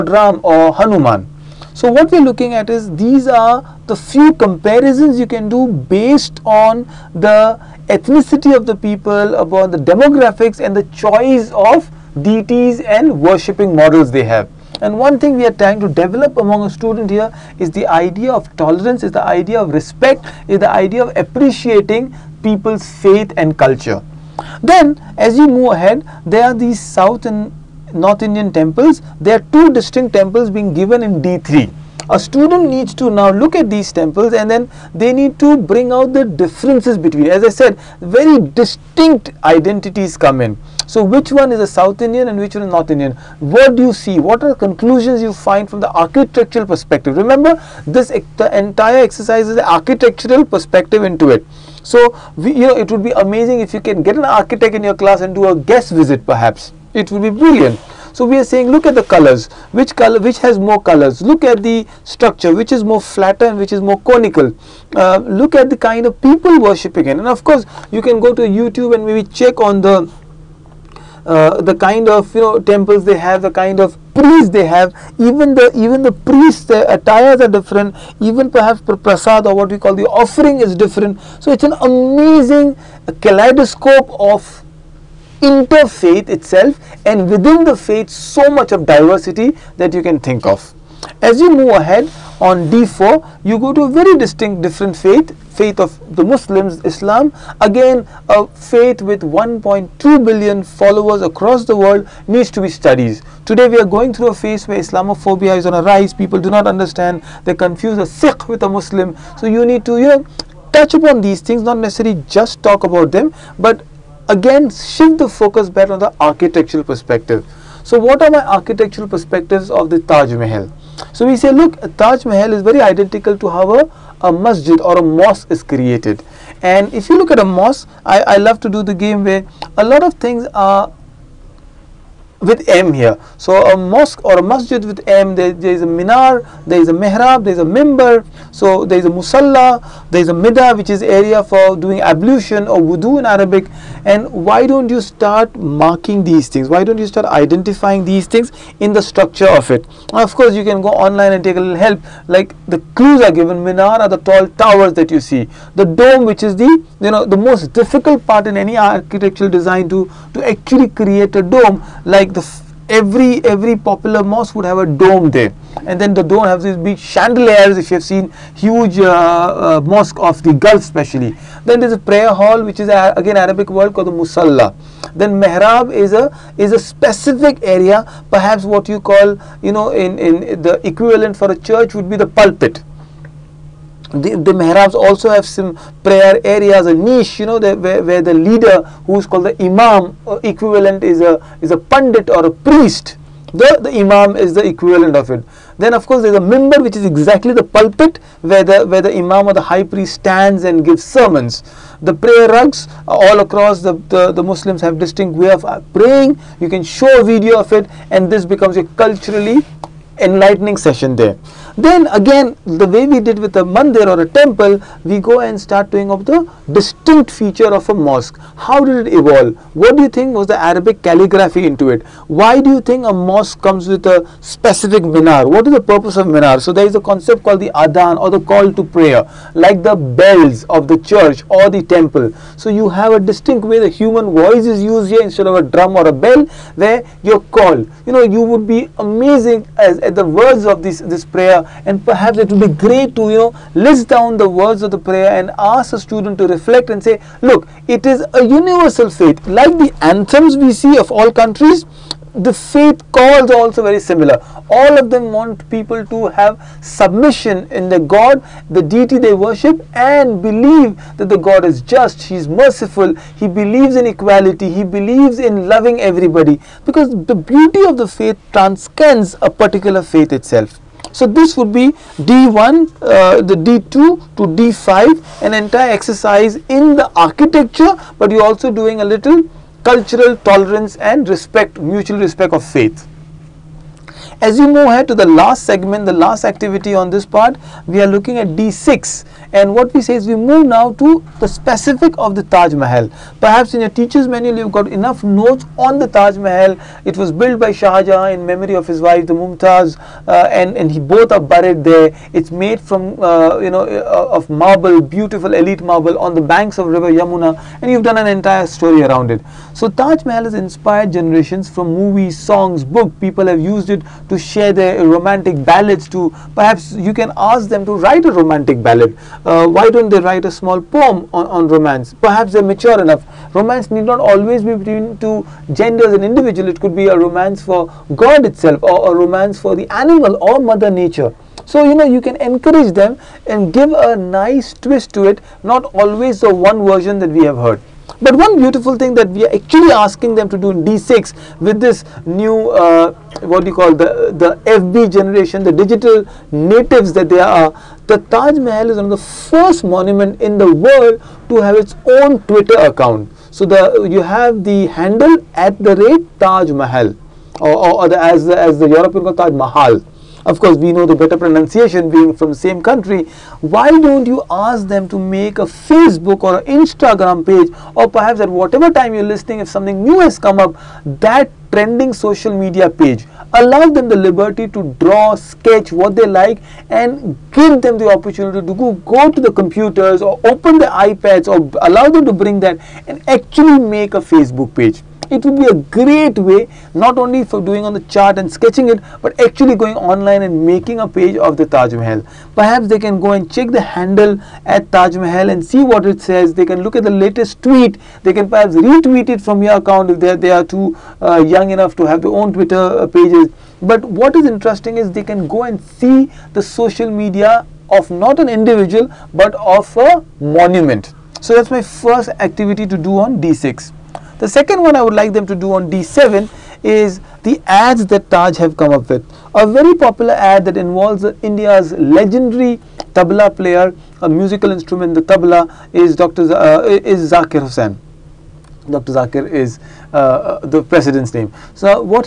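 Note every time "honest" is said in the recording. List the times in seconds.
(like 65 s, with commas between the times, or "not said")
not said.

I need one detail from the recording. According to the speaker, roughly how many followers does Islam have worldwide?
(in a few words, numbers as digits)
1.2 billion.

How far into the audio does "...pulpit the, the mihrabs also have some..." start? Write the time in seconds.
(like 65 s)
182 s.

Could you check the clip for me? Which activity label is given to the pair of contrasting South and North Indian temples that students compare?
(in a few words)
D3.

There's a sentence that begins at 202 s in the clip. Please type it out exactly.
The prayer rugs all across the, the, the Muslims have distinct way of uh, praying.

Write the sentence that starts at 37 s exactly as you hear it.
As I said, very distinct identities come in.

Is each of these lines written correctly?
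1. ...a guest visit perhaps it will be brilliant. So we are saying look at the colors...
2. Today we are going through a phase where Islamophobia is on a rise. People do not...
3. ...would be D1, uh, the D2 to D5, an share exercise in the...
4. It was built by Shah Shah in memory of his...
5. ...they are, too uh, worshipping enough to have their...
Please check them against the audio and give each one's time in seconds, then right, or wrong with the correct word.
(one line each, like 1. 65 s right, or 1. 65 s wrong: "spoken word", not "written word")
1. 55 s right
2. 103 s right
3. 271 s wrong: "entire", not "share"
4. 297 s wrong: "Jahan", not "Shah"
5. 400 s wrong: "young", not "worshipping".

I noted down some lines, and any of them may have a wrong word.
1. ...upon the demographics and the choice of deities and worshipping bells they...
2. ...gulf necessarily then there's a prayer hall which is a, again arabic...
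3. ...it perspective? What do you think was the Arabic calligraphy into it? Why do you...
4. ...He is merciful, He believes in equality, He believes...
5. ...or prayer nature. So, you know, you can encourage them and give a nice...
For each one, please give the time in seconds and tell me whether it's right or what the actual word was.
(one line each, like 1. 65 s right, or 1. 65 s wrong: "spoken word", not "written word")
1. 9 s wrong: "models", not "bells"
2. 170 s wrong: "especially", not "necessarily"
3. 219 s wrong: "evolve", not "perspective"
4. 262 s right
5. 330 s wrong: "mother", not "prayer".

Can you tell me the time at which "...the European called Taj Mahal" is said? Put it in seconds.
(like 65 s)
358 s.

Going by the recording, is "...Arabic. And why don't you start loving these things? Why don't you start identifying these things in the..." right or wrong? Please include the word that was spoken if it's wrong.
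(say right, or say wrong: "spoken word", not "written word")
wrong: "marking", not "loving".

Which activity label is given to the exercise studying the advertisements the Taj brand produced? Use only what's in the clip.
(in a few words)
D7.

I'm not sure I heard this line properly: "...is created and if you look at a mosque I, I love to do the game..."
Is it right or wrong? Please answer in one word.
right.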